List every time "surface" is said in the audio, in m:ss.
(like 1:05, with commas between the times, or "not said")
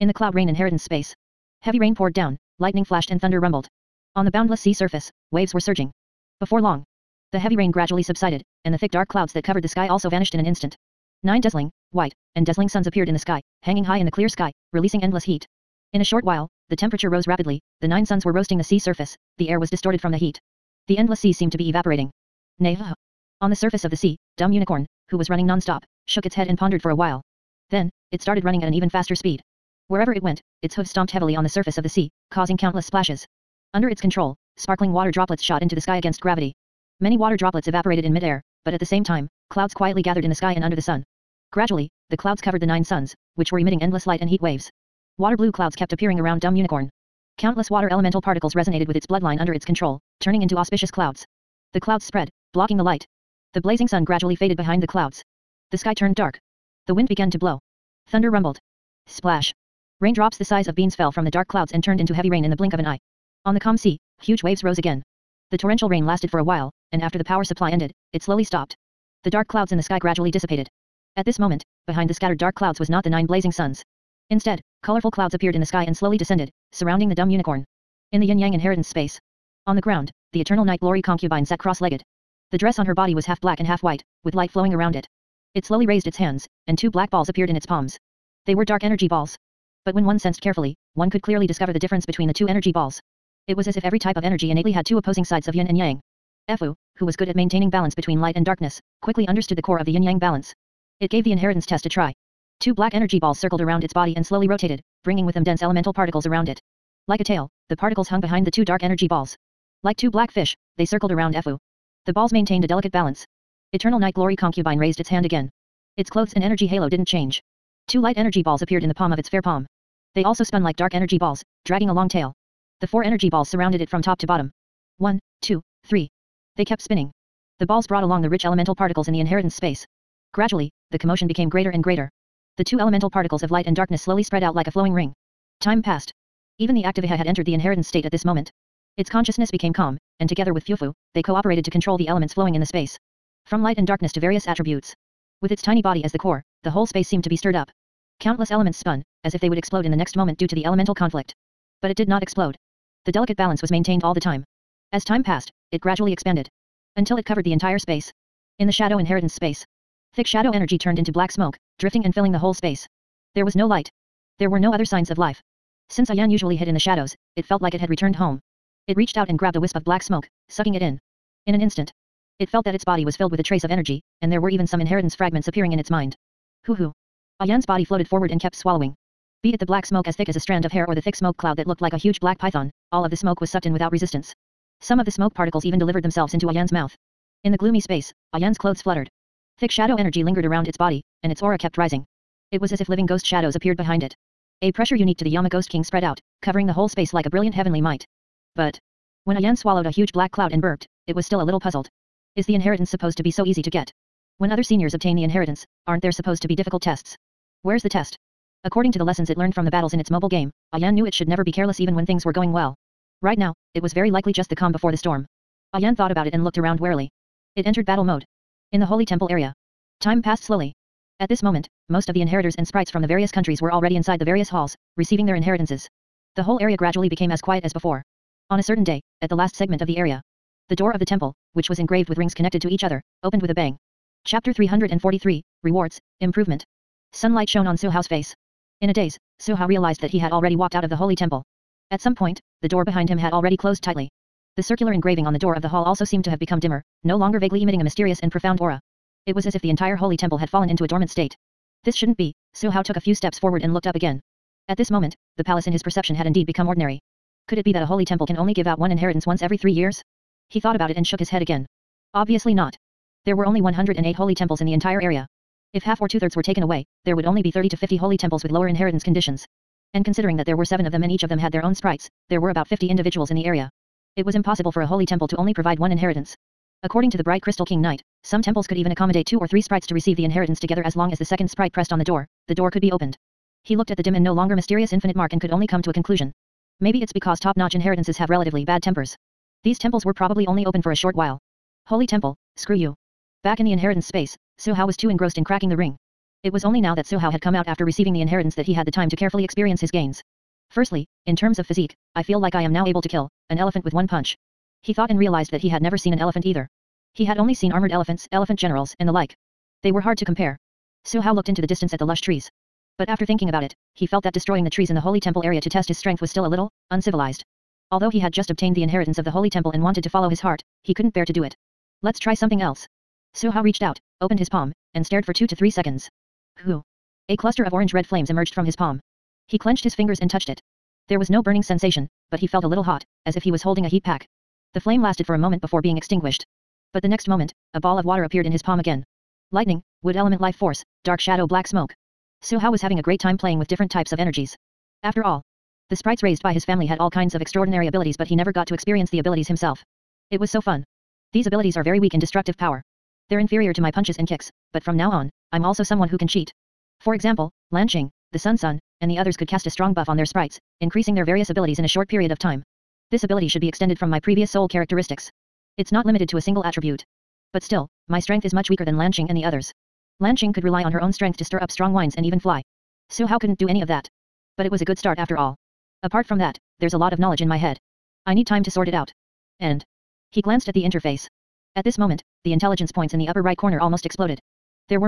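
0:04, 0:18, 0:23, 0:31.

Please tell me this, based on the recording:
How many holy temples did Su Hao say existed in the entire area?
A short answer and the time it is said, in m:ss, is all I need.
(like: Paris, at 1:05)
108, at 4:23.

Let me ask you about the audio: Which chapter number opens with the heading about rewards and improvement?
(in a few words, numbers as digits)
343.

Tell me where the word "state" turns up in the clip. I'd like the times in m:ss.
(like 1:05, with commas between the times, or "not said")
2:17, 4:11.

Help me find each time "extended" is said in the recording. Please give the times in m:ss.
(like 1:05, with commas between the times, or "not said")
6:03.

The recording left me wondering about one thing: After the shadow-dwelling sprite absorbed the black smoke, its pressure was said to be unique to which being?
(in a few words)
Yama Ghost King.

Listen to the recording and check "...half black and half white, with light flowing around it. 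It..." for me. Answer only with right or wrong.
right.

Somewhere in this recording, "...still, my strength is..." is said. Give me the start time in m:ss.
6:07.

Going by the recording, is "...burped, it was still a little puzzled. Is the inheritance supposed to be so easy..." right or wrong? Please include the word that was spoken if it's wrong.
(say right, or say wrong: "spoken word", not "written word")
right.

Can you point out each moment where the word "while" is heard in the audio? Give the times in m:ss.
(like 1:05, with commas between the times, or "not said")
0:16, 0:26, 1:06, 4:51.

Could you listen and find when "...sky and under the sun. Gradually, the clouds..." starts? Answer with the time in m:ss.
0:40.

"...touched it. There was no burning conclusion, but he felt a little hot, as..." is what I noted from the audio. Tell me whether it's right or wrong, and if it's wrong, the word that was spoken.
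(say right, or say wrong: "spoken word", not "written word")
wrong: "sensation", not "conclusion".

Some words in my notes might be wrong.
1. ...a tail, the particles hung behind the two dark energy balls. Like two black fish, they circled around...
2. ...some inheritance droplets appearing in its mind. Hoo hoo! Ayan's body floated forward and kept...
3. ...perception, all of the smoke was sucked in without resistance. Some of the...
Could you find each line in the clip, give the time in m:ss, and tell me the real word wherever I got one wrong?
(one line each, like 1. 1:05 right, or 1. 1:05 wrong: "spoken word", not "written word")
1. 1:47 right
2. 2:54 wrong: "fragments", not "droplets"
3. 3:02 wrong: "python", not "perception".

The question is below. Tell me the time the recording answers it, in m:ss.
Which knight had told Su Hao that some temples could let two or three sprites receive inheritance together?
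4:37.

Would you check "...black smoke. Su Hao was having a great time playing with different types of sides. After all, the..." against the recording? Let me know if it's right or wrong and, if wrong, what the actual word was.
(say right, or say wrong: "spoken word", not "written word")
wrong: "energies", not "sides".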